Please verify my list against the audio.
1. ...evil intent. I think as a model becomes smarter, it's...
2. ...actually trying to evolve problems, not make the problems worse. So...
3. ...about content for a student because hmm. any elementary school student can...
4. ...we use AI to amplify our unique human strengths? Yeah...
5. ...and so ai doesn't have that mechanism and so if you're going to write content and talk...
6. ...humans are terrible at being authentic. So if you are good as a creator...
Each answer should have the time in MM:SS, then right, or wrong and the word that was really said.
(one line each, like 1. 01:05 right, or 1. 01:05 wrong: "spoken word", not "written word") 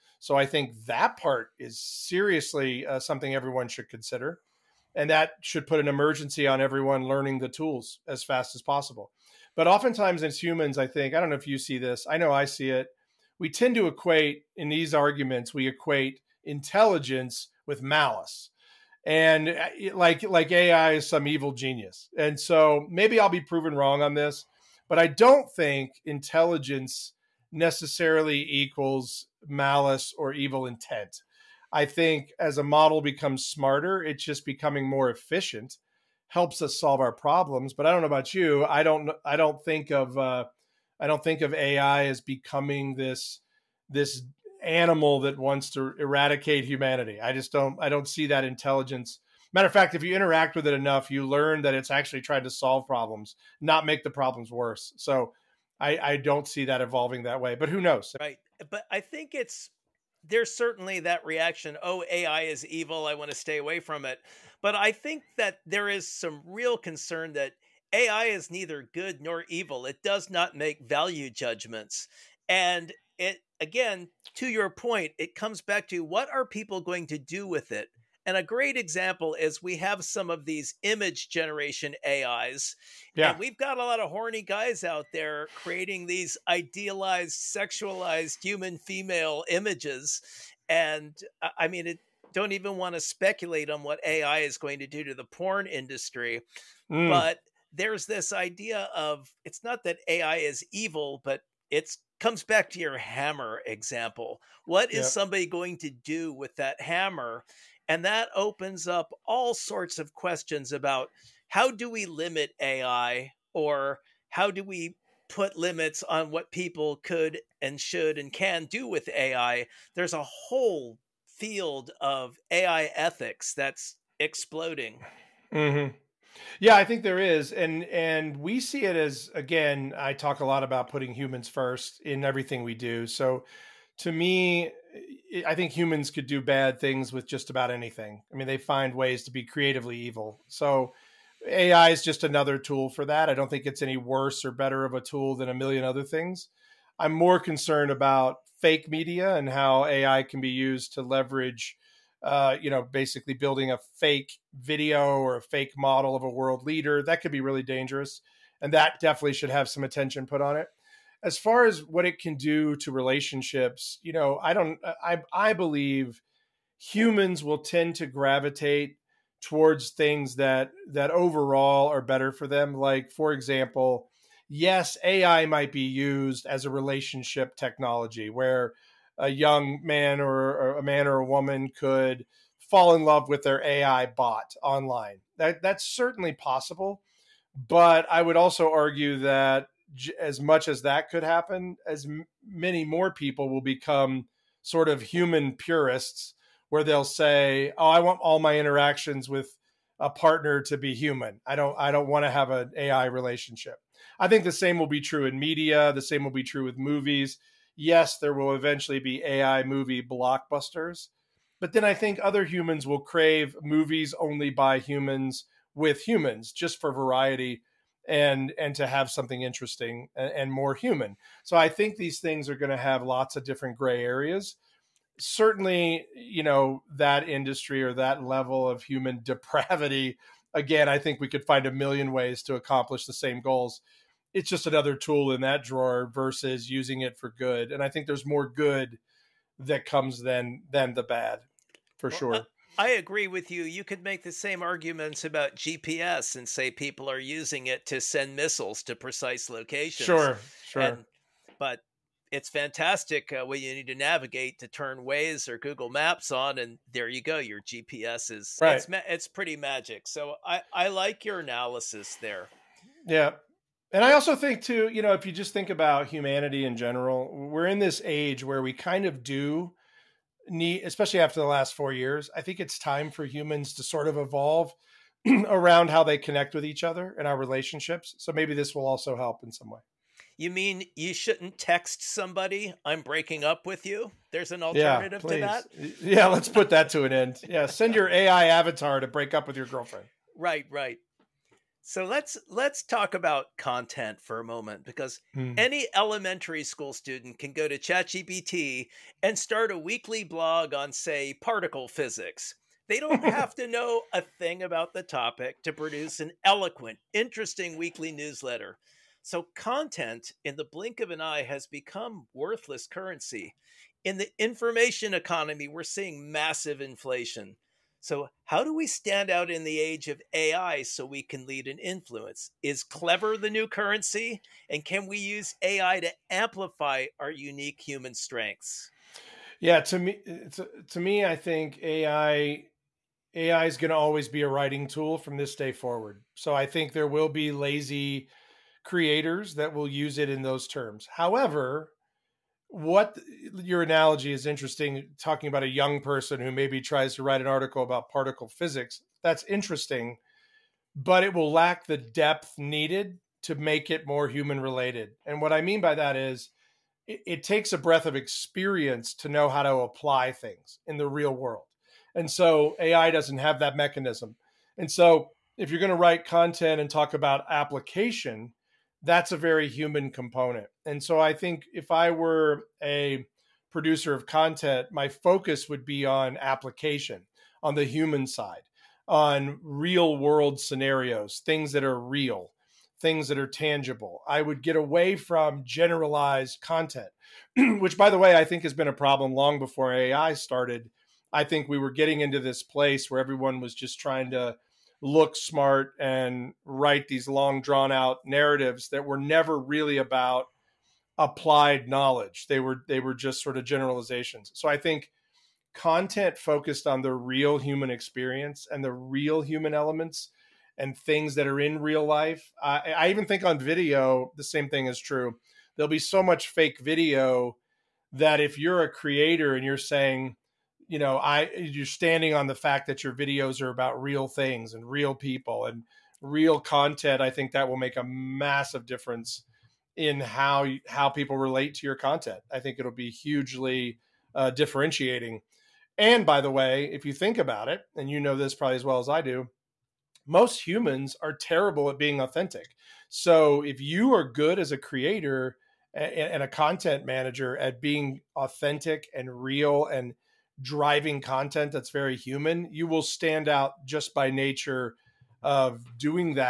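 1. 00:30 right
2. 00:51 wrong: "solve", not "evolve"
3. 04:53 wrong: "moment", not "student"
4. 05:25 right
5. 06:02 right
6. 07:20 right.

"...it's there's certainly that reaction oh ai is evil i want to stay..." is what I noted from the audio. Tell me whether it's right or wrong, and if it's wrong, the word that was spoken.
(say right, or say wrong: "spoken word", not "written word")
right.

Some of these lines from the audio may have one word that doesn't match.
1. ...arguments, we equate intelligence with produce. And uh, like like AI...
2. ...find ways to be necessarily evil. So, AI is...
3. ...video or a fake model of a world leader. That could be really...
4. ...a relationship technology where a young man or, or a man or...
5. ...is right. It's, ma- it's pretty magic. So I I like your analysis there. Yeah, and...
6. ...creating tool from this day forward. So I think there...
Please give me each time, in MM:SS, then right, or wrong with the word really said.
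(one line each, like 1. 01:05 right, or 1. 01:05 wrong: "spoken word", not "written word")
1. 00:14 wrong: "malice", not "produce"
2. 02:18 wrong: "creatively", not "necessarily"
3. 02:34 right
4. 02:56 right
5. 04:18 right
6. 05:34 wrong: "writing", not "creating".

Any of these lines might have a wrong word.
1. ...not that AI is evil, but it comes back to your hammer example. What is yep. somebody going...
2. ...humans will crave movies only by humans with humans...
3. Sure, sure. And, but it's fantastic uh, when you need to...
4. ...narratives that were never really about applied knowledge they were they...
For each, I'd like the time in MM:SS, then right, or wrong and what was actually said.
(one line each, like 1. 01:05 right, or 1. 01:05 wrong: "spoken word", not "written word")
1. 01:39 right
2. 03:32 right
3. 04:10 right
4. 06:38 right.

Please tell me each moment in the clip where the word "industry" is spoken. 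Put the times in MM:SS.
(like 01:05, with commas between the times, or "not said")
01:35, 03:47.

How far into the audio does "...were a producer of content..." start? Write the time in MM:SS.
06:12.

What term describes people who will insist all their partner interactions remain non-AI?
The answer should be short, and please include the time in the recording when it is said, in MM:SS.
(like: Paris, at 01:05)
human purists, at 03:15.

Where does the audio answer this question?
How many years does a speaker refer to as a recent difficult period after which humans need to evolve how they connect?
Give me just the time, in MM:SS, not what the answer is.
04:31.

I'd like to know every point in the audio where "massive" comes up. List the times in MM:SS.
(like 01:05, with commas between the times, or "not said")
05:16, 07:08.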